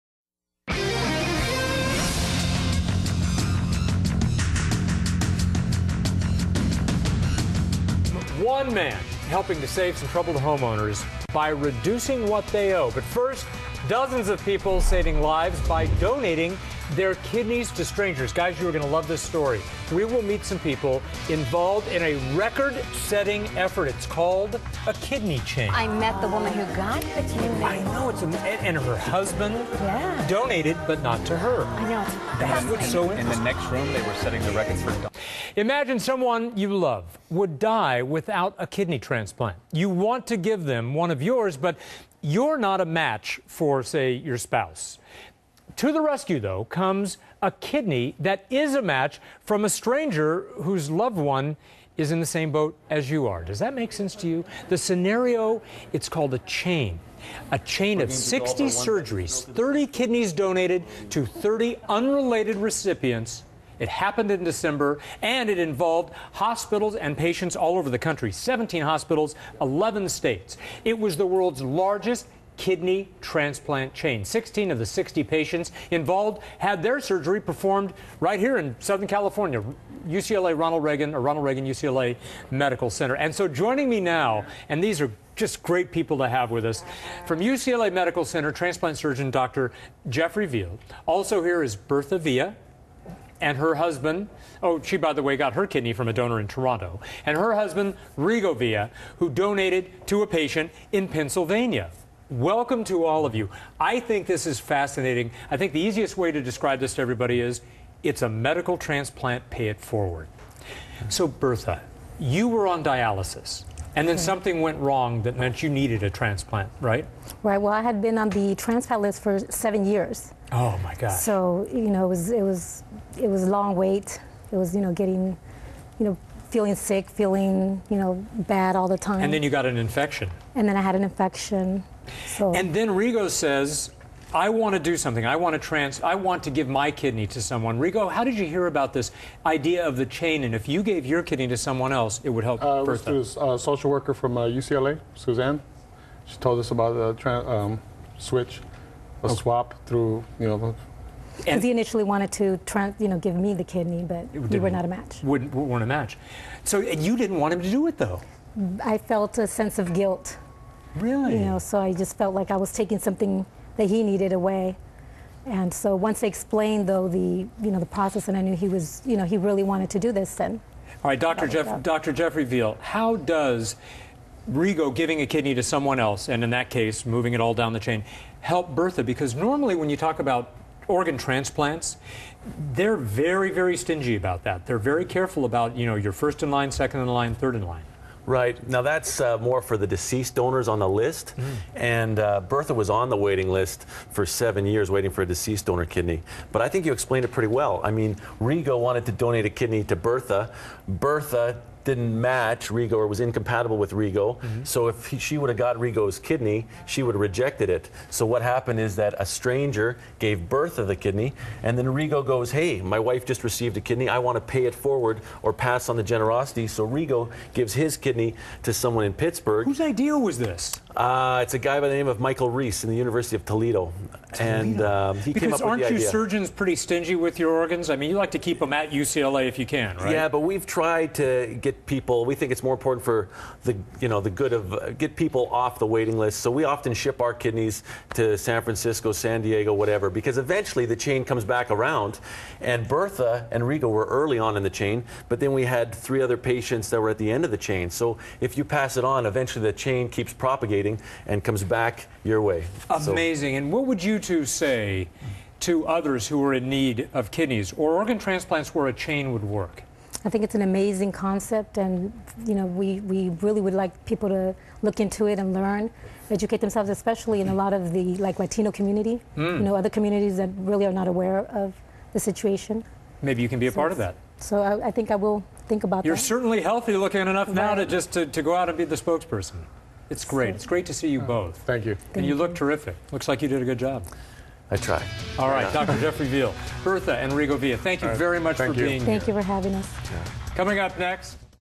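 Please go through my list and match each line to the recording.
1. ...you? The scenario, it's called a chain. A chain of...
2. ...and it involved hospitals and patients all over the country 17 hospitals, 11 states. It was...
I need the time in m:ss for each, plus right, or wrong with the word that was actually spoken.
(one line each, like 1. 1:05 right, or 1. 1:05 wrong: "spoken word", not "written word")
1. 0:54 right
2. 1:05 right.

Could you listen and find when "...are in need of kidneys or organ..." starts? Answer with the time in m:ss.
4:16.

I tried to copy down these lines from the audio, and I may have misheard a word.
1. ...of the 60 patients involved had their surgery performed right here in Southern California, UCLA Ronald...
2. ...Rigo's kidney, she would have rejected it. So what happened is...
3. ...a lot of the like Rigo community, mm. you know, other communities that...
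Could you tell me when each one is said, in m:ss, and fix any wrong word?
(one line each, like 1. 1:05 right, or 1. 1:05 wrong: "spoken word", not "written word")
1. 1:14 right
2. 3:25 right
3. 4:27 wrong: "Latino", not "Rigo".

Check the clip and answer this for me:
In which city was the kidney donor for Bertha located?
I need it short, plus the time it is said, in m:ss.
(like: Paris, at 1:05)
Toronto, at 1:36.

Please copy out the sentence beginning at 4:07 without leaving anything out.
So if you pass it on, eventually the chain keeps propagating dating and comes back your way.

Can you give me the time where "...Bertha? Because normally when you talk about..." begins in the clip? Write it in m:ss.
2:58.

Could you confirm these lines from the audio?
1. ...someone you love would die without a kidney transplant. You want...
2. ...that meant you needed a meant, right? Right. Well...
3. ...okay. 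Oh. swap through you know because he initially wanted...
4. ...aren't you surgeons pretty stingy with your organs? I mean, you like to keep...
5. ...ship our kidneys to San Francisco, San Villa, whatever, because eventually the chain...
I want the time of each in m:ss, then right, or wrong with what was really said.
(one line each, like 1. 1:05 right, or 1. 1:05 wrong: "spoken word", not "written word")
1. 0:35 right
2. 1:55 wrong: "transplant", not "meant"
3. 2:29 right
4. 3:45 right
5. 3:56 wrong: "Diego", not "Villa".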